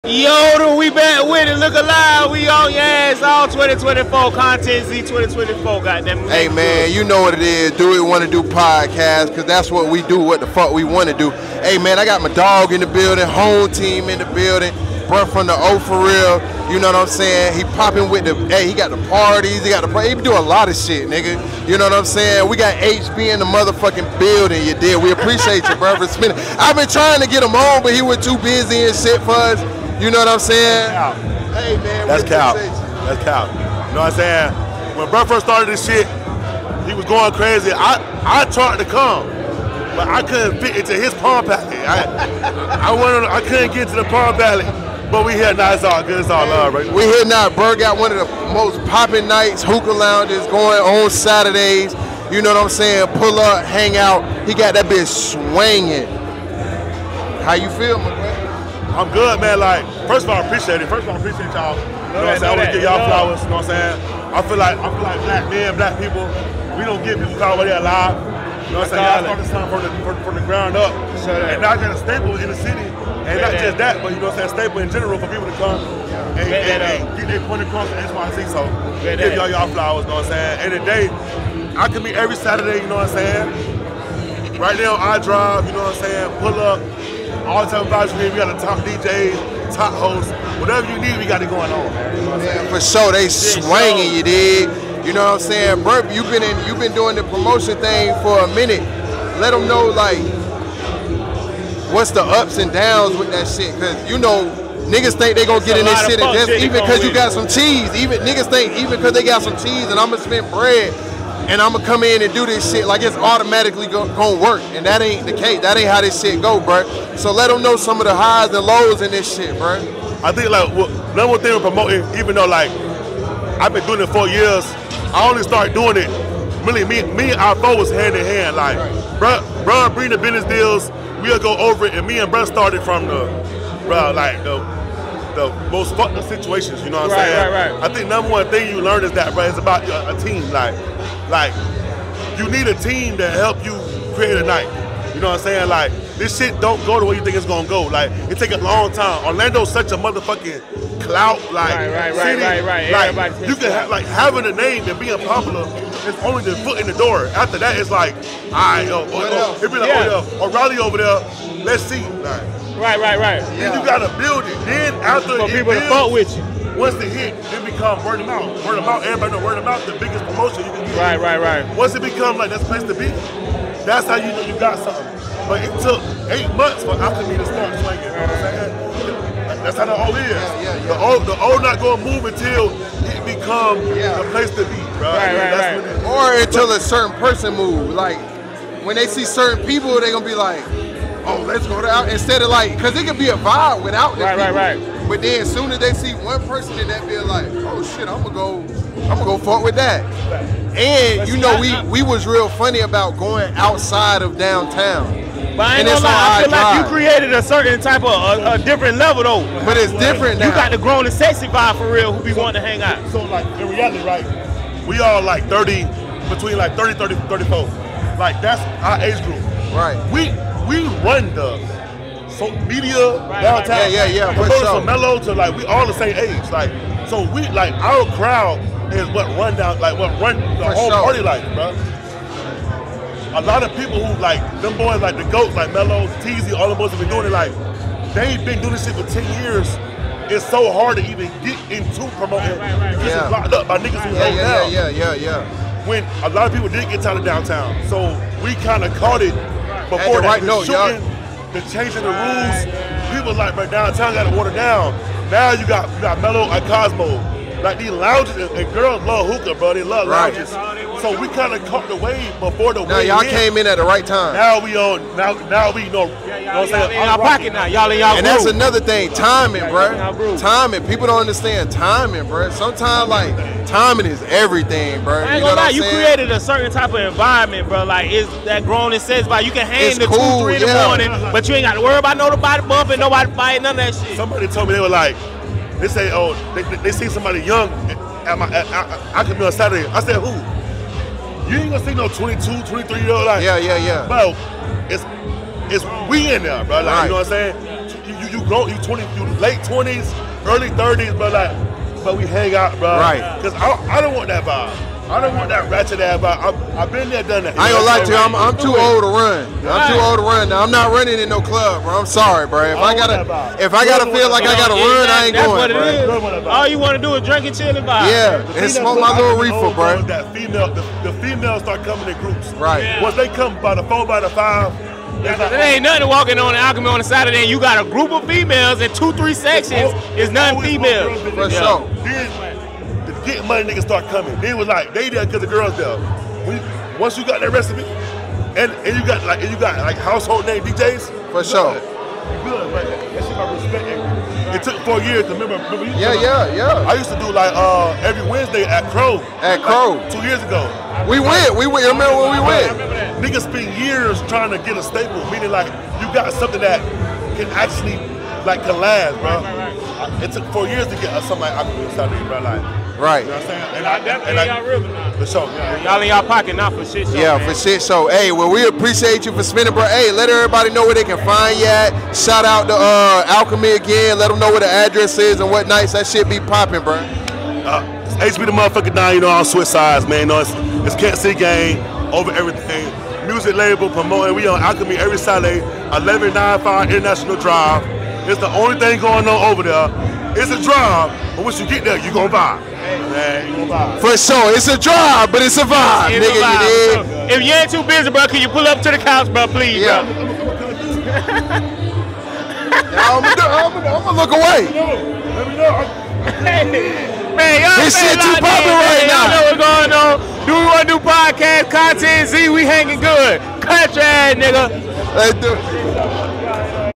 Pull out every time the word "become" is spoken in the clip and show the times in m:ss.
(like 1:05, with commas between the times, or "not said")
2:47, 2:52, 3:03.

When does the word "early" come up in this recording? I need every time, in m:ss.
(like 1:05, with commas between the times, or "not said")
5:00.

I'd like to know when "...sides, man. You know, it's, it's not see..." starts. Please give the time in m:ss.
6:19.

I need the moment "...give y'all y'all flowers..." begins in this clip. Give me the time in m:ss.
1:19.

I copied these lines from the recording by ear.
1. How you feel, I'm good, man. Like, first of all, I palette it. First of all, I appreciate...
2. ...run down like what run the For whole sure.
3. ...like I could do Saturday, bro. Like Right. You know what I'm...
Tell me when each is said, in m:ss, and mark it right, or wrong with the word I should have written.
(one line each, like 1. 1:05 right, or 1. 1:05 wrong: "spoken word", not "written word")
1. 0:57 wrong: "appreciate", not "palette"
2. 3:49 right
3. 6:01 right.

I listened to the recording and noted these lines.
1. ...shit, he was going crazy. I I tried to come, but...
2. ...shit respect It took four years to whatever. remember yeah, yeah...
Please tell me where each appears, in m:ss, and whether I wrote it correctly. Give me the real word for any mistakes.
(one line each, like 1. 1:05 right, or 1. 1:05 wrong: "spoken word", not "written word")
1. 0:35 right
2. 5:42 wrong: "remember", not "whatever".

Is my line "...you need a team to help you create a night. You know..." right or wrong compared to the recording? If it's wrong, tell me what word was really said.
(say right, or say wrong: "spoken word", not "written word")
right.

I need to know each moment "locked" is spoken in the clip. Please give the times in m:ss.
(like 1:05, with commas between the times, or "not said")
4:03.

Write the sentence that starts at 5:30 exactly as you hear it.
It's none females For sure get money niggas start coming.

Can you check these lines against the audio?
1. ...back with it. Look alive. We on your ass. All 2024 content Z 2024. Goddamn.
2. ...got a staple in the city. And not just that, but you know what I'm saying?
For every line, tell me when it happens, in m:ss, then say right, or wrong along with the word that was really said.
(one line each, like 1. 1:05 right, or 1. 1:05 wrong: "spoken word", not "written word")
1. 0:00 right
2. 1:11 right.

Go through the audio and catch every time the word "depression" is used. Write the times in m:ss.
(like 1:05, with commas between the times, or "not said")
not said.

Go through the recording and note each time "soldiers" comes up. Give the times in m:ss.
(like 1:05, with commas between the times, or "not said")
not said.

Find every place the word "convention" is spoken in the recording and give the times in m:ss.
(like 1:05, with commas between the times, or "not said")
not said.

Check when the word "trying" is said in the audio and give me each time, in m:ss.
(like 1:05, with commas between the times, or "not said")
0:26, 5:54.